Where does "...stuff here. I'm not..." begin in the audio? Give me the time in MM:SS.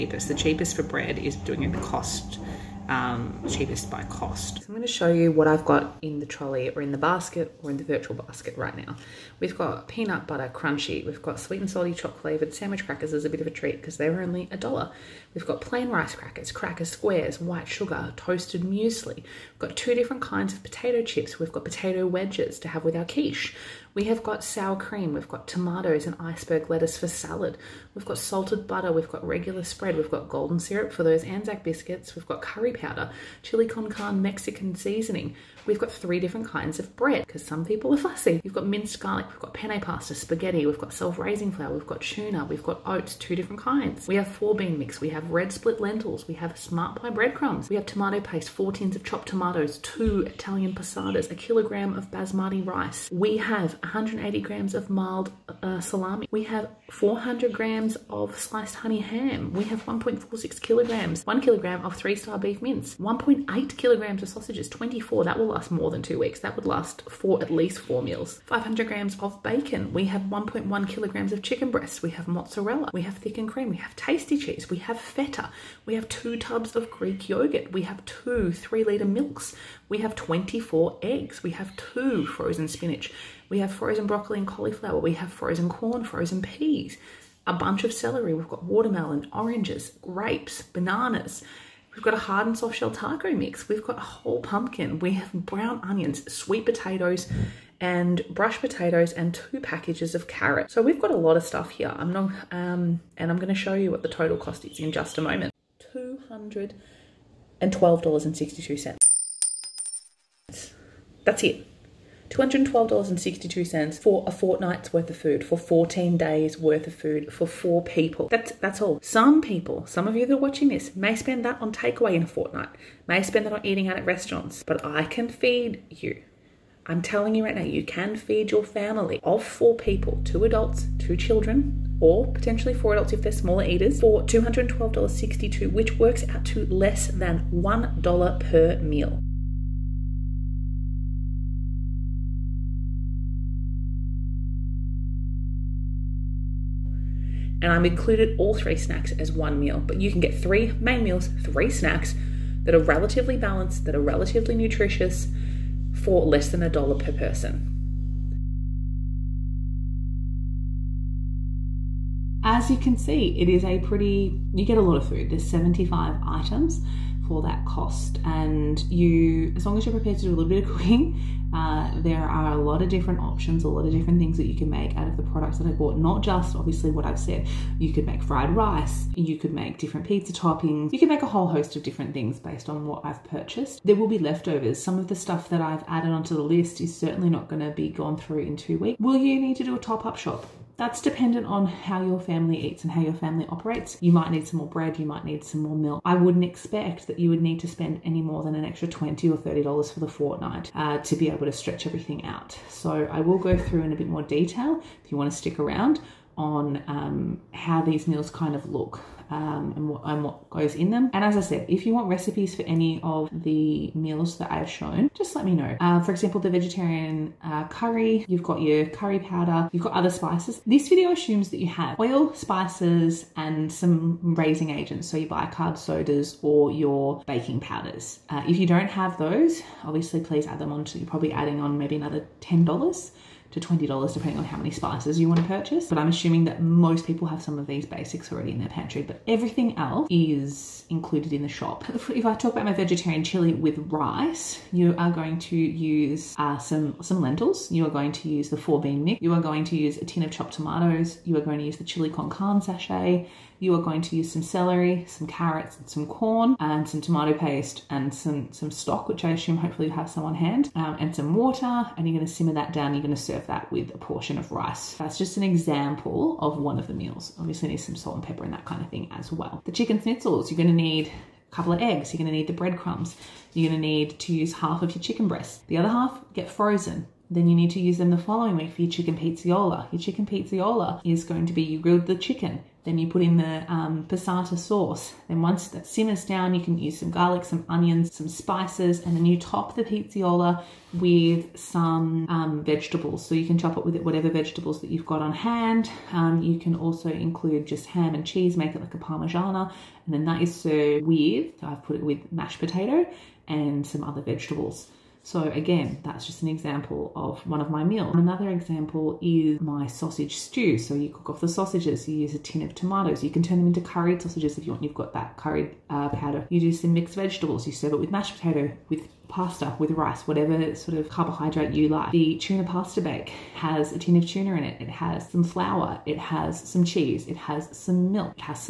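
01:41.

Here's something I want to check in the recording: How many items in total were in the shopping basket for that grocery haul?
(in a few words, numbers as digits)
75.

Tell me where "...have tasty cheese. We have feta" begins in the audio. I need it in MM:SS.
01:13.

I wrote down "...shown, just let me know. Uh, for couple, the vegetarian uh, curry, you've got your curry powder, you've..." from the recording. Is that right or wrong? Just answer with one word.
wrong.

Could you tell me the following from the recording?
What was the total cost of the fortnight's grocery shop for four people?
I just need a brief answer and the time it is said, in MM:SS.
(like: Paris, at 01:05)
$212.62, at 01:45.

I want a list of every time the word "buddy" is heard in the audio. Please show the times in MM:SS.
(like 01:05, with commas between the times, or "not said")
not said.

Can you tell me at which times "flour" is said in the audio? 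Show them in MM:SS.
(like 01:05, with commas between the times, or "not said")
00:41, 05:25.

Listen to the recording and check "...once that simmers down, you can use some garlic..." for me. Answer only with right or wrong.
right.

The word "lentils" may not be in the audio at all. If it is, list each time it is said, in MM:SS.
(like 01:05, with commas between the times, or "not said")
00:45, 04:07.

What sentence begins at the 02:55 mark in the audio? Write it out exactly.
Not just obviously what I've said.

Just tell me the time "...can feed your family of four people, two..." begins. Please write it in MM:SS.
02:07.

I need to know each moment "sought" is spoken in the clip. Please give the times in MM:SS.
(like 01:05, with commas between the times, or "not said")
not said.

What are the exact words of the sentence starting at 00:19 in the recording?
We've got two different kinds of potato chips.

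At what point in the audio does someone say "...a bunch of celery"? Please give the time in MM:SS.
01:27.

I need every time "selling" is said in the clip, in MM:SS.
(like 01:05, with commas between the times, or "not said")
not said.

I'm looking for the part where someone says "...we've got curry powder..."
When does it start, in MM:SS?
00:32.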